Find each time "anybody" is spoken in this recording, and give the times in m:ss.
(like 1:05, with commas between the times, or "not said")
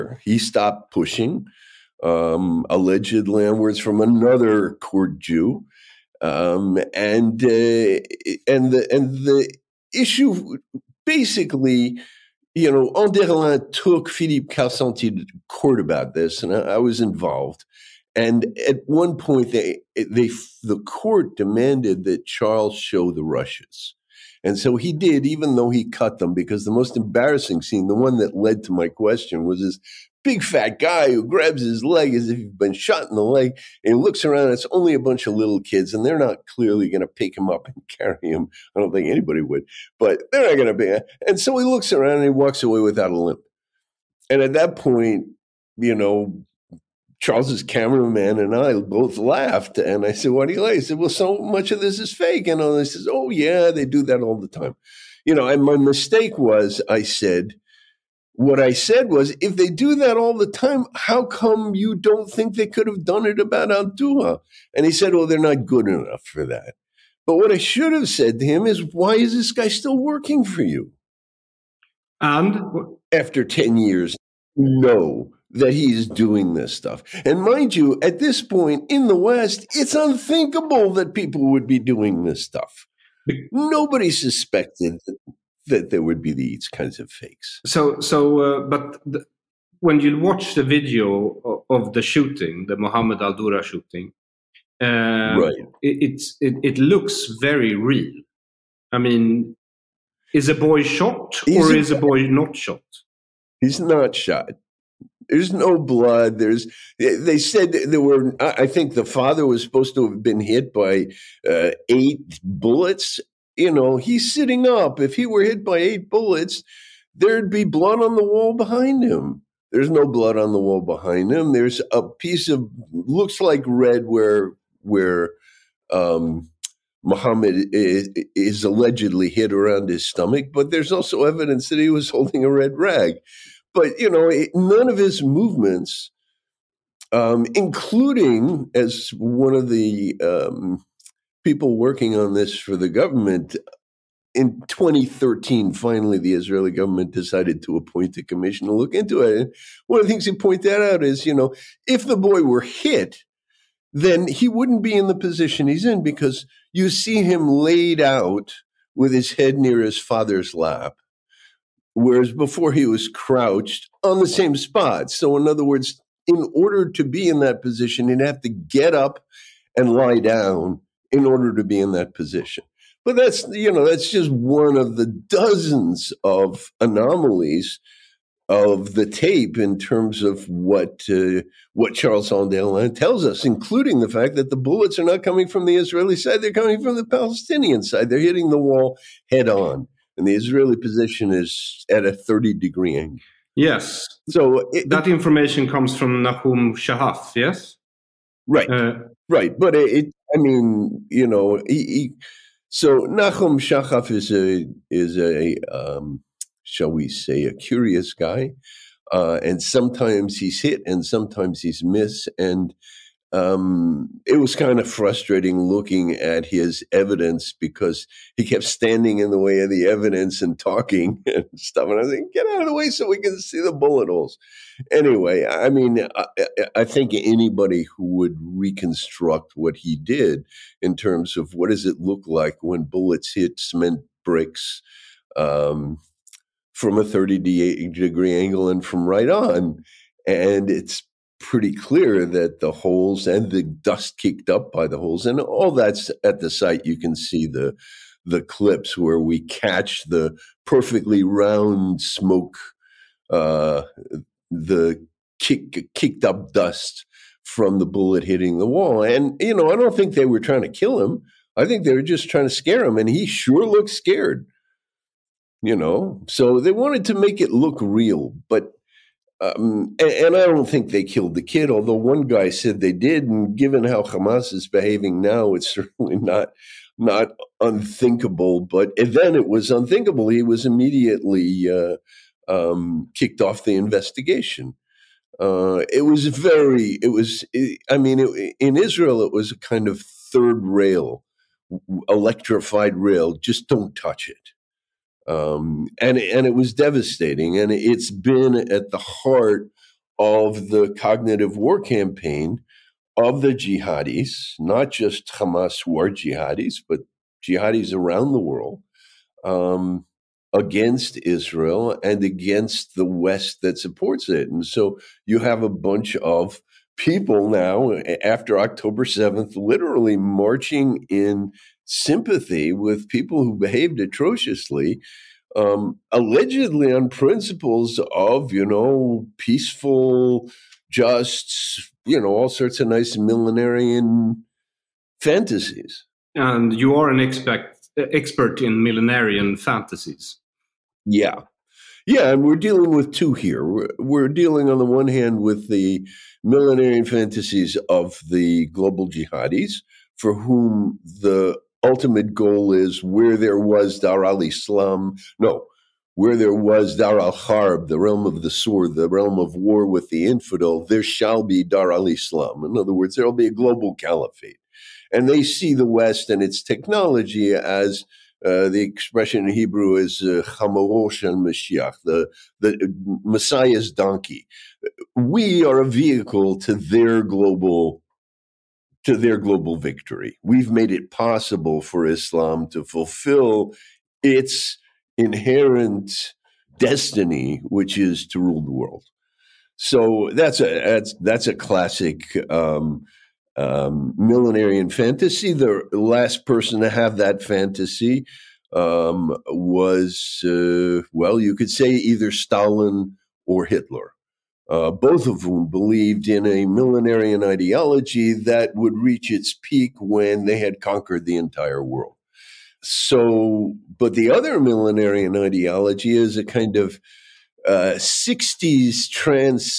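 0:39, 3:47.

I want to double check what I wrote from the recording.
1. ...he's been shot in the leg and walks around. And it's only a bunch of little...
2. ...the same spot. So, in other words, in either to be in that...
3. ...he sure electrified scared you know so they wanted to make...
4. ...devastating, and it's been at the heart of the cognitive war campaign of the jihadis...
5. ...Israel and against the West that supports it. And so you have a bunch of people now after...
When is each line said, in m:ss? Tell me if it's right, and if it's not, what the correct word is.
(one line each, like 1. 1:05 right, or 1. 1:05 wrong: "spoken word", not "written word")
1. 0:32 wrong: "looks", not "walks"
2. 2:44 wrong: "order", not "either"
3. 4:23 wrong: "looked", not "electrified"
4. 4:56 right
5. 5:11 right.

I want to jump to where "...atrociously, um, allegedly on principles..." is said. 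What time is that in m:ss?
5:23.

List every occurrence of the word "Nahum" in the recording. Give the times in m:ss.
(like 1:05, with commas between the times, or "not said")
3:16, 3:23.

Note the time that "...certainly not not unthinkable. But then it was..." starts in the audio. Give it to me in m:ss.
4:35.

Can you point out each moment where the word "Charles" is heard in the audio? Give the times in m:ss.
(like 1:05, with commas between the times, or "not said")
0:22, 0:47, 3:01.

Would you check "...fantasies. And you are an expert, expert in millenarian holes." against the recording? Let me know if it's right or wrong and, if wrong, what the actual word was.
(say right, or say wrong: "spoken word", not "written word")
wrong: "fantasies", not "holes".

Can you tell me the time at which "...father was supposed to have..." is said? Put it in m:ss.
1:49.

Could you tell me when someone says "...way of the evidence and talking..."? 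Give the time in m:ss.
3:39.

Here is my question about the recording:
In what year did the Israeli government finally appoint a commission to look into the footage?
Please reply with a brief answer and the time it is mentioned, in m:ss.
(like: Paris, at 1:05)
2013, at 2:24.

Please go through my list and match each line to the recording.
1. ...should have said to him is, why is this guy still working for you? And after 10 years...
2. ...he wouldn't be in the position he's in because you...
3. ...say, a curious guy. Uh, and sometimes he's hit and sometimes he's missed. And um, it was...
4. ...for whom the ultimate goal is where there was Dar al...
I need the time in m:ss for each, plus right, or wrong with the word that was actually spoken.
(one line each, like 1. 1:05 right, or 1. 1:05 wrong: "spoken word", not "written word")
1. 1:07 right
2. 2:34 right
3. 3:27 right
4. 5:50 right.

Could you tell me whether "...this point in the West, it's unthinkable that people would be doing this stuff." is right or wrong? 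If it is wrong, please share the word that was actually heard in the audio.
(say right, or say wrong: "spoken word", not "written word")
right.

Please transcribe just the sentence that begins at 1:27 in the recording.
So, so, uh, but the, when you watch the video of, of the shooting, the Mohammed Al Dura shooting, uh, right.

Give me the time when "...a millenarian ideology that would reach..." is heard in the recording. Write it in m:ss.
6:46.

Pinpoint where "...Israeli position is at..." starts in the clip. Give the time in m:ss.
3:10.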